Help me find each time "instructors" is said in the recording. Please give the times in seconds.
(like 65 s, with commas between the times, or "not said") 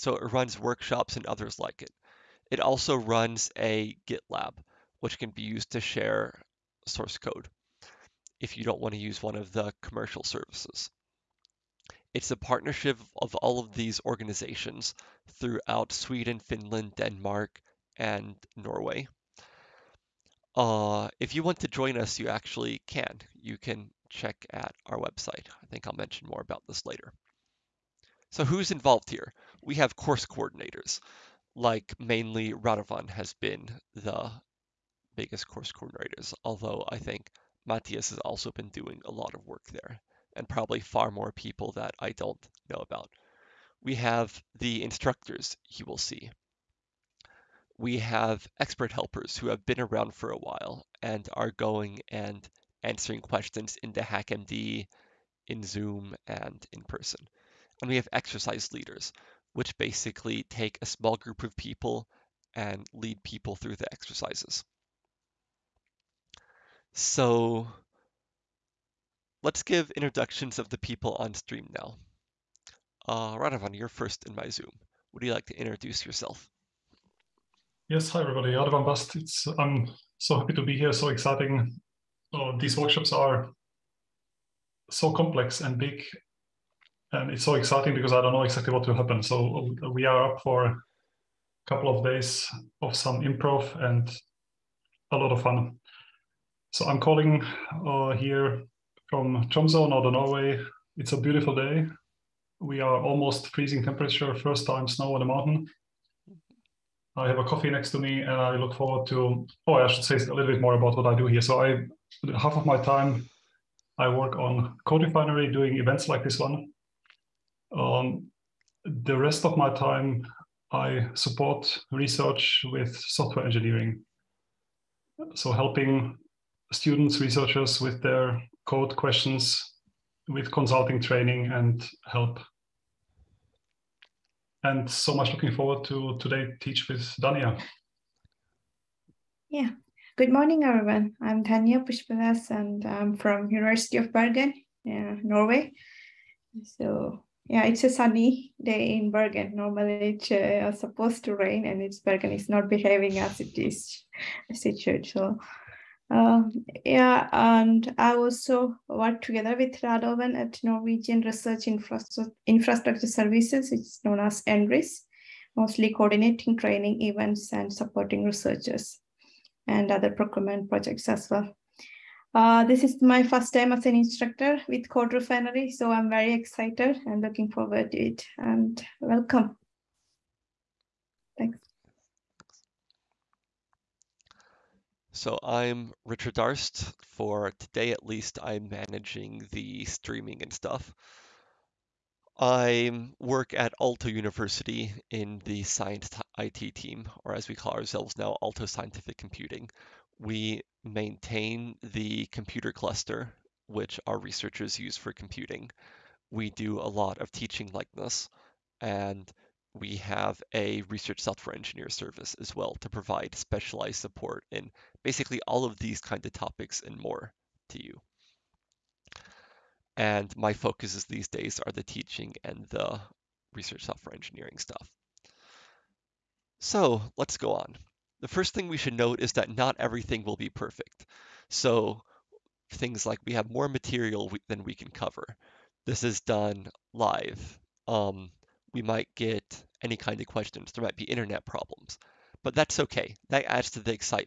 44 s, 173 s.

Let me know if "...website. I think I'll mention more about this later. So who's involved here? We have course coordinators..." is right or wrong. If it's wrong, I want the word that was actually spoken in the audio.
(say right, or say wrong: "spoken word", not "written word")
right.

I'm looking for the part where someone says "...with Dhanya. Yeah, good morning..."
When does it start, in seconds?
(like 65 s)
136 s.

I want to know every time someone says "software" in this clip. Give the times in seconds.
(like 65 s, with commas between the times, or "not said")
122 s, 211 s, 223 s.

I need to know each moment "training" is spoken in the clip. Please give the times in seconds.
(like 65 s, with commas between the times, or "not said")
131 s, 166 s.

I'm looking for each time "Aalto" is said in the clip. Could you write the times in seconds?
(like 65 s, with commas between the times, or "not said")
193 s, 198 s.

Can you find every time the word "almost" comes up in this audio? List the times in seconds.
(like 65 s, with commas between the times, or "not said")
103 s.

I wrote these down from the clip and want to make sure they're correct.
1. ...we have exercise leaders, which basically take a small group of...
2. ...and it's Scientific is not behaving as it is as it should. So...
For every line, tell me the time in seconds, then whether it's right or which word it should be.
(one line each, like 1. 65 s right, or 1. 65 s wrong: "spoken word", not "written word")
1. 57 s right
2. 151 s wrong: "Bergen", not "Scientific".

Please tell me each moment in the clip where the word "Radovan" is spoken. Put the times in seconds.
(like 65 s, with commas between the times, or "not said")
32 s, 73 s, 78 s, 159 s.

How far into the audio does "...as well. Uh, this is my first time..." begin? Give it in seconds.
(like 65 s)
171 s.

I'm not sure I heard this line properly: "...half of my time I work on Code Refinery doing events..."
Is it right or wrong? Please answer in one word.
right.